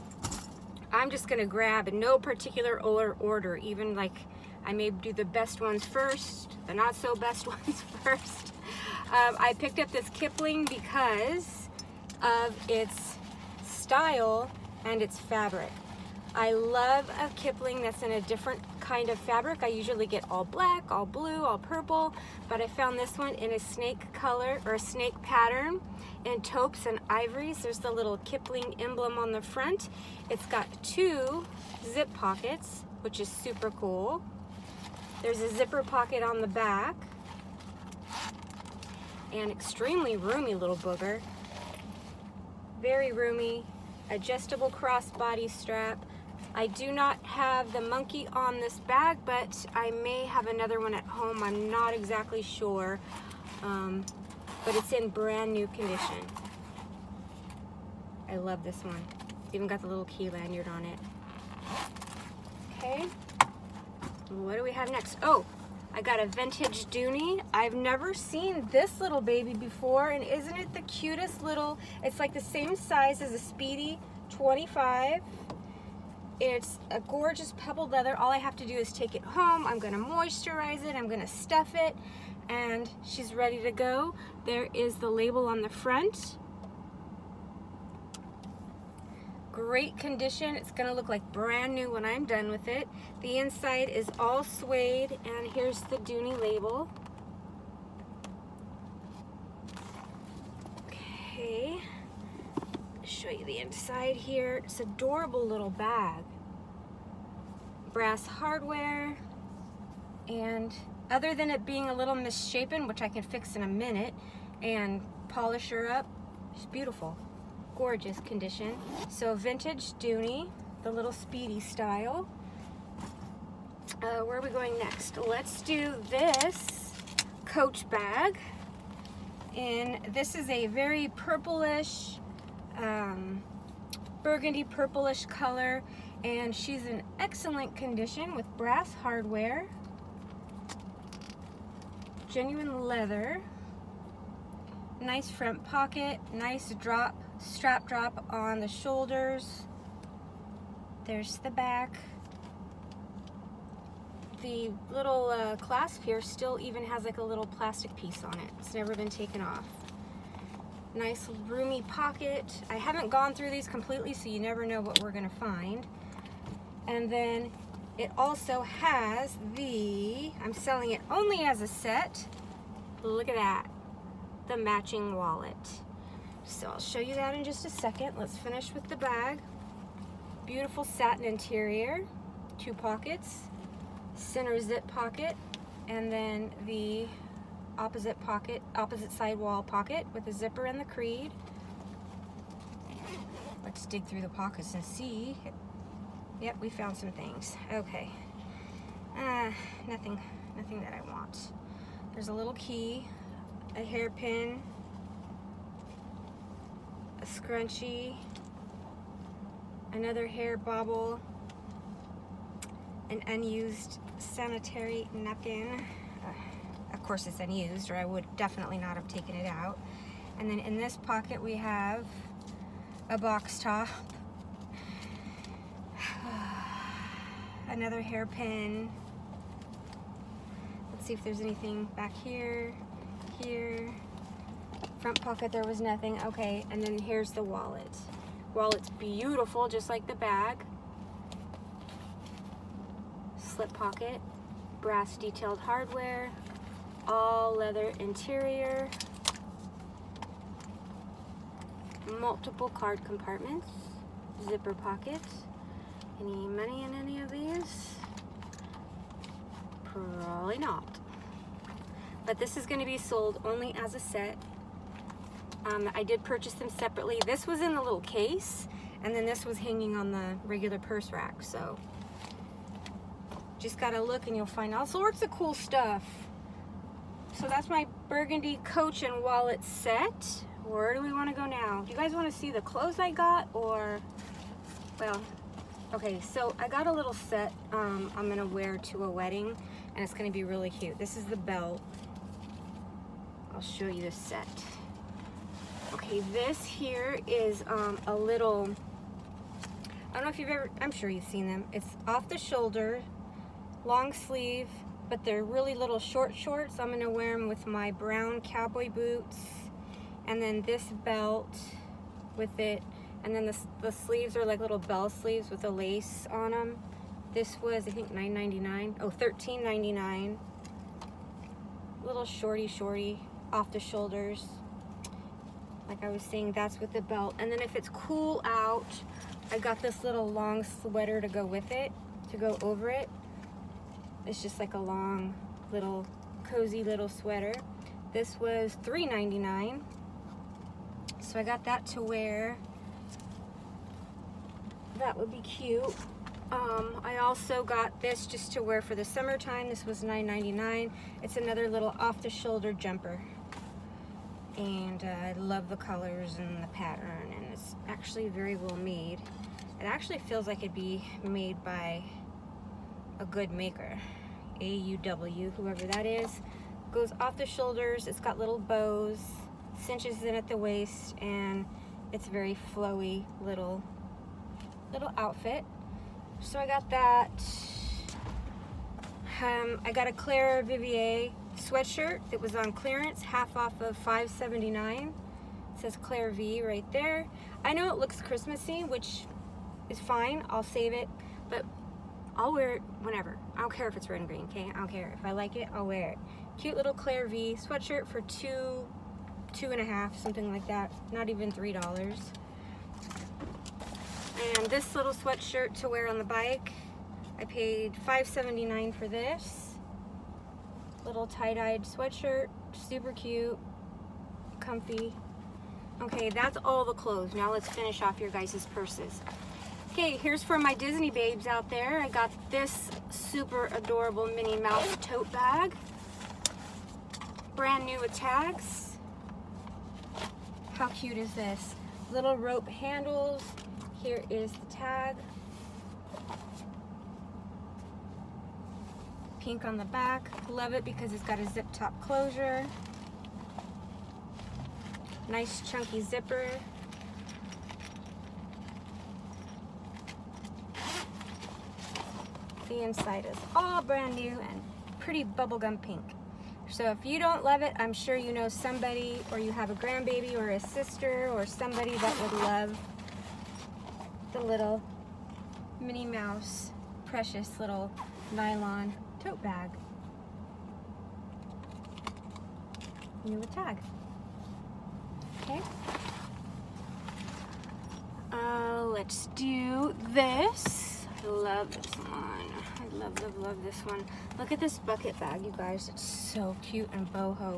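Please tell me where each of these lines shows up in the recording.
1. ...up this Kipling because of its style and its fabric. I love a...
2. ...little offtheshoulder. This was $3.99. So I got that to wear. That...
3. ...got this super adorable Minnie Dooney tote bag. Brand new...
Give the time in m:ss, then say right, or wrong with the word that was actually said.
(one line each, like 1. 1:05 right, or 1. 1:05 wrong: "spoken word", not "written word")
1. 0:09 right
2. 5:36 wrong: "sweater", not "offtheshoulder"
3. 7:02 wrong: "Mouse", not "Dooney".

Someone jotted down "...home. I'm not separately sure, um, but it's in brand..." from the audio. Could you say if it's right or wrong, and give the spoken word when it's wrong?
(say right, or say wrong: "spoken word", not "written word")
wrong: "exactly", not "separately".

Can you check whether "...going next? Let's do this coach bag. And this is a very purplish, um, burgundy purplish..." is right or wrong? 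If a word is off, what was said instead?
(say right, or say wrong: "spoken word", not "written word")
right.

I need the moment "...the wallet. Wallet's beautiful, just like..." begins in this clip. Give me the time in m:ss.
3:57.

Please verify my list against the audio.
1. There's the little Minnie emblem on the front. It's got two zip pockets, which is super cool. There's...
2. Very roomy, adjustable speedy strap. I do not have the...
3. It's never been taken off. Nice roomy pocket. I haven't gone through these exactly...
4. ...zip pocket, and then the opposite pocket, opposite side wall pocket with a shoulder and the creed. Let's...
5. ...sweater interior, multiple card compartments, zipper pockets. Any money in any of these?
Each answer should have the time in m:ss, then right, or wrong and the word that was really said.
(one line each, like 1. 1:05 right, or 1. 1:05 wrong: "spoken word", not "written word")
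1. 0:27 wrong: "Kipling", not "Minnie"
2. 0:42 wrong: "crossbody", not "speedy"
3. 2:38 wrong: "completely", not "exactly"
4. 3:04 wrong: "zipper", not "shoulder"
5. 4:07 wrong: "leather", not "sweater".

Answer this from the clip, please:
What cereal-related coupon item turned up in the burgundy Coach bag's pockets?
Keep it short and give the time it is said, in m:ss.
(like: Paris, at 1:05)
A box top, at 3:43.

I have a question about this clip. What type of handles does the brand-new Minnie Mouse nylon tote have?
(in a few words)
Rope handles.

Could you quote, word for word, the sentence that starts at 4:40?
Where do we wanna go now?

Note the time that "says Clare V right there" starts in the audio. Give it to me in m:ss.
6:25.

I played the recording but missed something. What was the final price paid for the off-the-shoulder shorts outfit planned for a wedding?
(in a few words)
$13.99.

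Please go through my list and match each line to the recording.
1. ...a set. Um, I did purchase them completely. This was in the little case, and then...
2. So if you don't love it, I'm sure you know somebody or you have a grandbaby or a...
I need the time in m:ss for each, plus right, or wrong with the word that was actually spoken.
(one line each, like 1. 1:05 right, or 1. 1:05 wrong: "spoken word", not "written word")
1. 4:23 wrong: "separately", not "completely"
2. 7:36 right.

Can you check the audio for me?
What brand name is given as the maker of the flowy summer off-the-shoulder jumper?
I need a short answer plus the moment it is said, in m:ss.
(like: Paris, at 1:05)
AUW, at 6:04.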